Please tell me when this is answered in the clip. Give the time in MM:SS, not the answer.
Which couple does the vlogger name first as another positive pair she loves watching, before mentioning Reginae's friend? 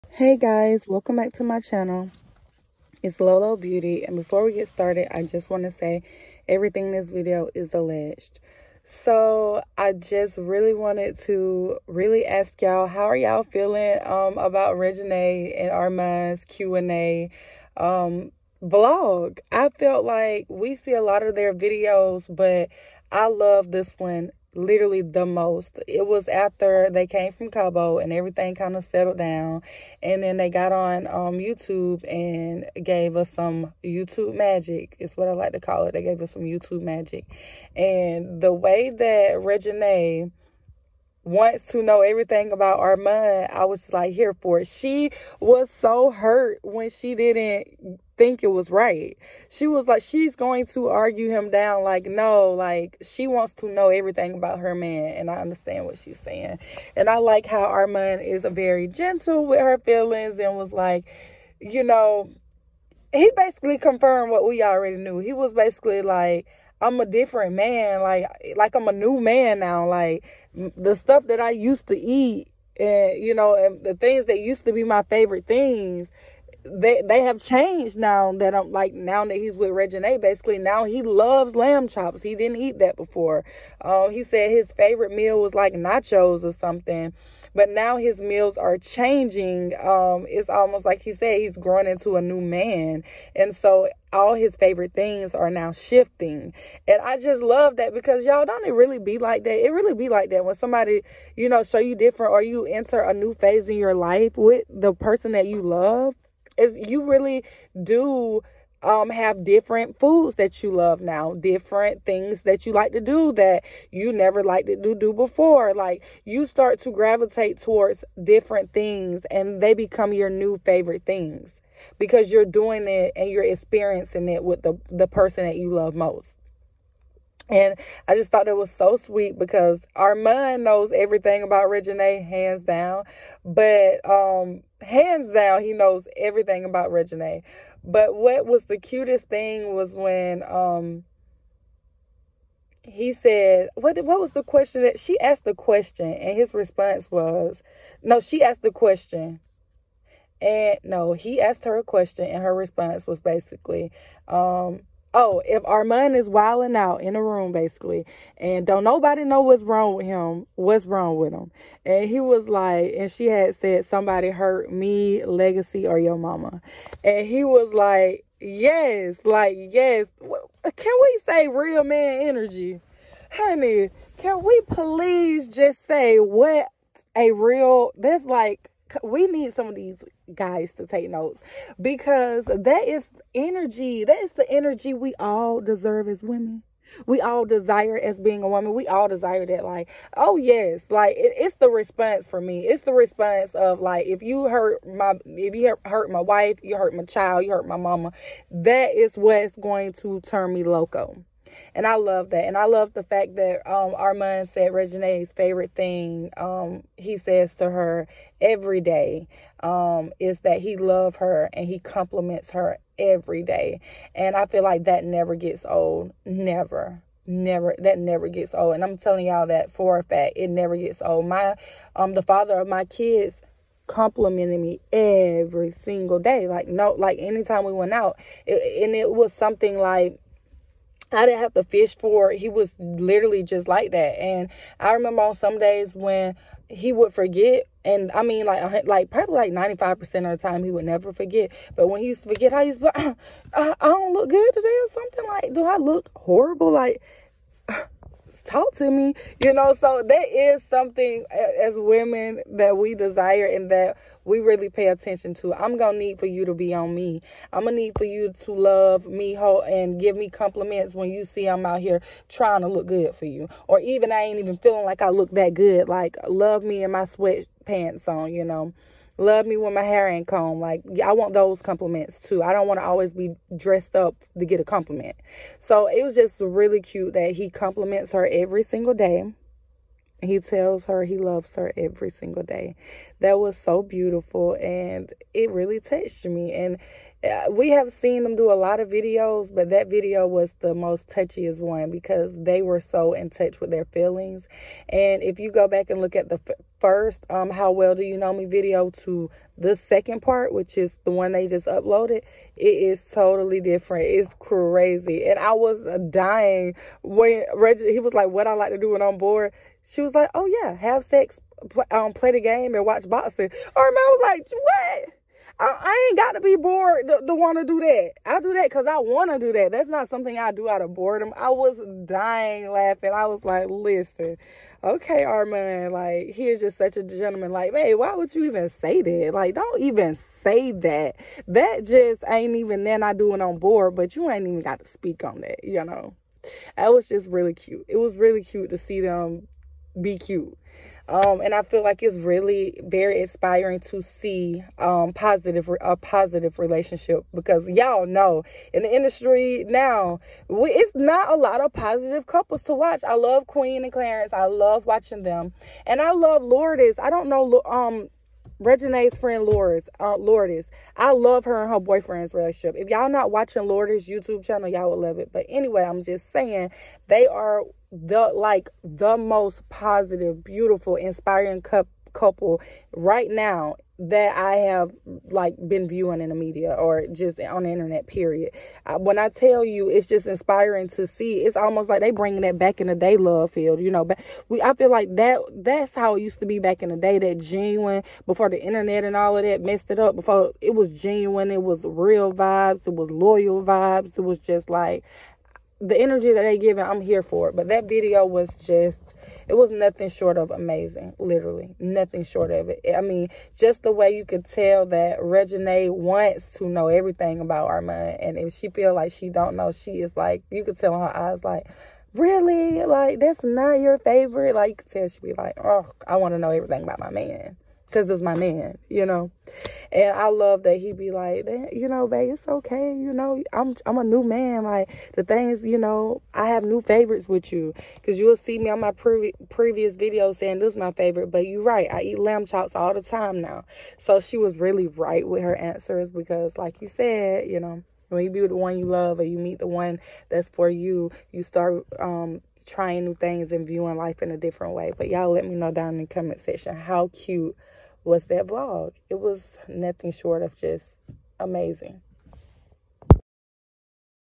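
05:53.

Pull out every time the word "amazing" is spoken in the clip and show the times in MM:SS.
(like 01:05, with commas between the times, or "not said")
06:40, 07:31.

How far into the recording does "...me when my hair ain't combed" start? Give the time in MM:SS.
04:29.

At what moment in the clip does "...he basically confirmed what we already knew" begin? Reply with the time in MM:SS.
01:03.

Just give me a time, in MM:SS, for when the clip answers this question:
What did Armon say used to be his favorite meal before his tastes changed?
01:25.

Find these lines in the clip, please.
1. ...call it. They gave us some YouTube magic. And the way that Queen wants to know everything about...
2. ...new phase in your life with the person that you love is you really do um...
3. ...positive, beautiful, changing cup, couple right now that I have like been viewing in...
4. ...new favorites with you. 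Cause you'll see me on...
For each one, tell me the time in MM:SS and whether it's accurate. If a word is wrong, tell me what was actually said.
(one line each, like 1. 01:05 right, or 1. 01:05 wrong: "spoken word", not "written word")
1. 00:35 wrong: "Reginae", not "Queen"
2. 01:43 right
3. 06:09 wrong: "inspiring", not "changing"
4. 07:06 right.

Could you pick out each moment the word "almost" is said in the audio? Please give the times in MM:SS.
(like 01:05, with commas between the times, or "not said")
01:30, 06:21.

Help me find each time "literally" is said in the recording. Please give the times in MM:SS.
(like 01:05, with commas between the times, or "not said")
00:24, 03:52, 06:41.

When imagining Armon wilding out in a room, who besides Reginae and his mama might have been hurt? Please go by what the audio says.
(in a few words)
Legacy.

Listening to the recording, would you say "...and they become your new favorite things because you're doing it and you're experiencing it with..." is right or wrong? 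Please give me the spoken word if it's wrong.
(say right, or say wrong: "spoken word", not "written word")
right.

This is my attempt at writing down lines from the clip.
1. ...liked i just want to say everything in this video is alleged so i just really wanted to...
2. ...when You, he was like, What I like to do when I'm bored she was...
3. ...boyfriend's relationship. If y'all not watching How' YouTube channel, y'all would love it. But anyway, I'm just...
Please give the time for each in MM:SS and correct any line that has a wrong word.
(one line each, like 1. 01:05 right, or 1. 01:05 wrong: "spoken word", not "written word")
1. 00:04 wrong: "started", not "liked"
2. 05:07 wrong: "Reggie", not "You"
3. 06:01 wrong: "Lourdes", not "How".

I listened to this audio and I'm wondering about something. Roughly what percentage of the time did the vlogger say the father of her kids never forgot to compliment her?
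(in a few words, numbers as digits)
95%.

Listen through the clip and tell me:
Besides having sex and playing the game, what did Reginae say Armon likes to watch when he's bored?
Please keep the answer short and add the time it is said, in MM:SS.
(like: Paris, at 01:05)
Boxing, at 05:13.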